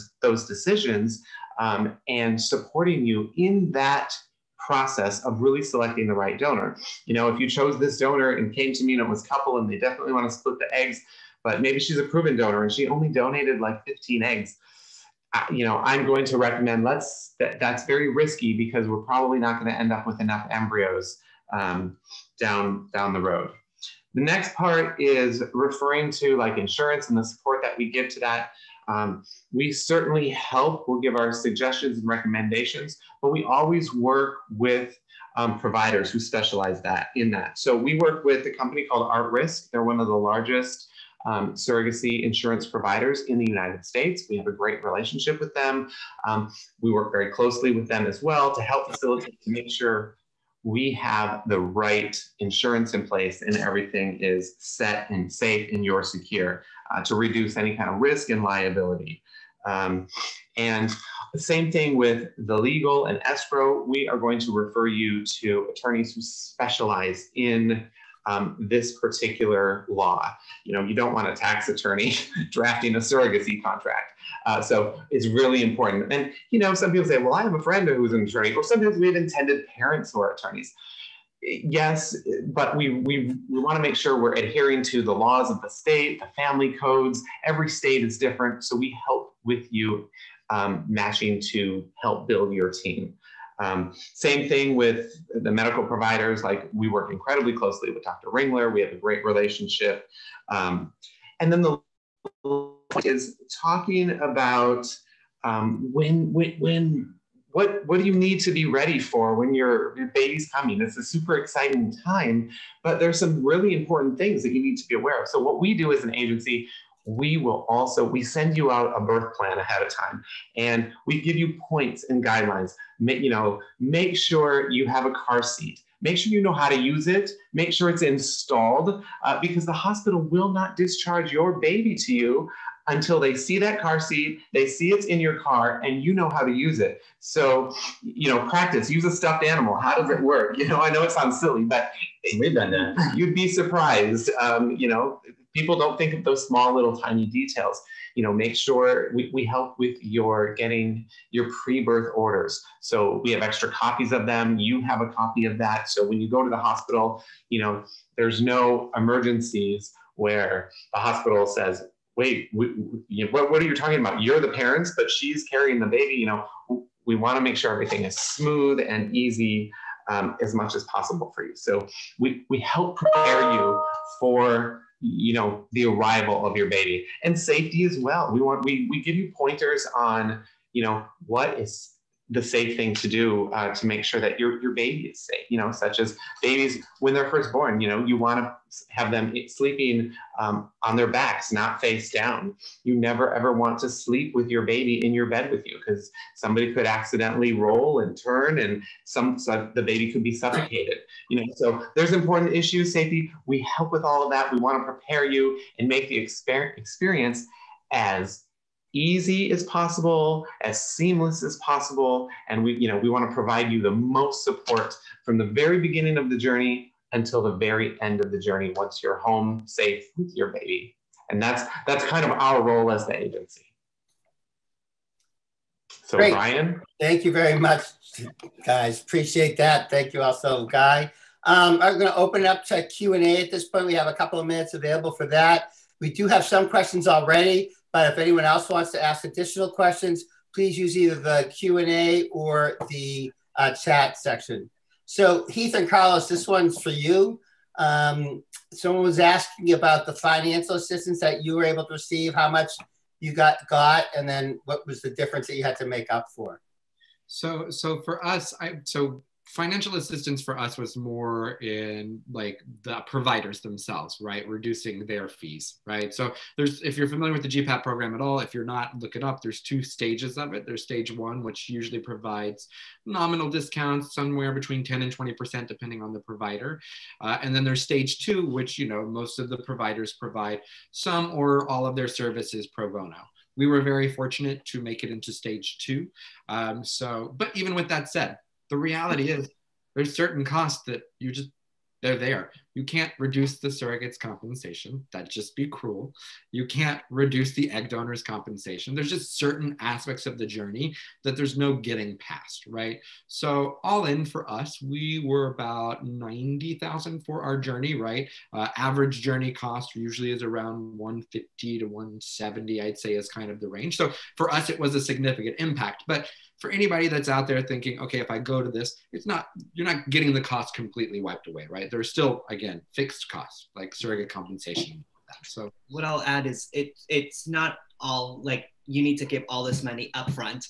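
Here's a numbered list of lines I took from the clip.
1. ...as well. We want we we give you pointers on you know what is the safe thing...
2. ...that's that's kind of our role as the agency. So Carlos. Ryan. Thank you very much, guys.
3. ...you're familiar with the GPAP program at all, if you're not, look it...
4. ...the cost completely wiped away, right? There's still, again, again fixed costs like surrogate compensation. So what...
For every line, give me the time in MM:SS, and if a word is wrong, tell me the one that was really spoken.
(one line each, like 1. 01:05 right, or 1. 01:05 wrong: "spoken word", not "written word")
1. 02:57 right
2. 03:41 wrong: "Great", not "Carlos"
3. 04:26 right
4. 05:20 right.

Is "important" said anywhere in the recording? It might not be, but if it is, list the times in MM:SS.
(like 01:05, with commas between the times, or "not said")
01:15, 01:53, 03:22.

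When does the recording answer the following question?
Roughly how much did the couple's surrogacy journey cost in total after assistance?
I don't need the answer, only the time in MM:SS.
05:06.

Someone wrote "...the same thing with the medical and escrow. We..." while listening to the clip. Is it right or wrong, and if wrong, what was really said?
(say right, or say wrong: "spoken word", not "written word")
wrong: "legal", not "medical".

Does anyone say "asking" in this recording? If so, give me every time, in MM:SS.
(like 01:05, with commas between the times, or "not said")
04:09.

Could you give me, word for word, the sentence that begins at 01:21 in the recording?
Yes, but we, we, we want to make sure we're adhering to the laws of the state, the family codes.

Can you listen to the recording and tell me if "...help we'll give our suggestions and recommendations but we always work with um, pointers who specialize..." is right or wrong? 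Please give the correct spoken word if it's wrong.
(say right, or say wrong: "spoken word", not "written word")
wrong: "providers", not "pointers".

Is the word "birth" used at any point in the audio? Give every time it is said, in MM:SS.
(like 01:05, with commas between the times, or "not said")
01:58, 02:31.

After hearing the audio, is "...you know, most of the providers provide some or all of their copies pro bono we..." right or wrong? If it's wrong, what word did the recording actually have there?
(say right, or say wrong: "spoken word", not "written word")
wrong: "services", not "copies".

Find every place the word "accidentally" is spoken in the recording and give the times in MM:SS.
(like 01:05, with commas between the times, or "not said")
03:16.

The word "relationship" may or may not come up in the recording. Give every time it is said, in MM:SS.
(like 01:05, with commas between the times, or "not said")
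00:44, 01:39.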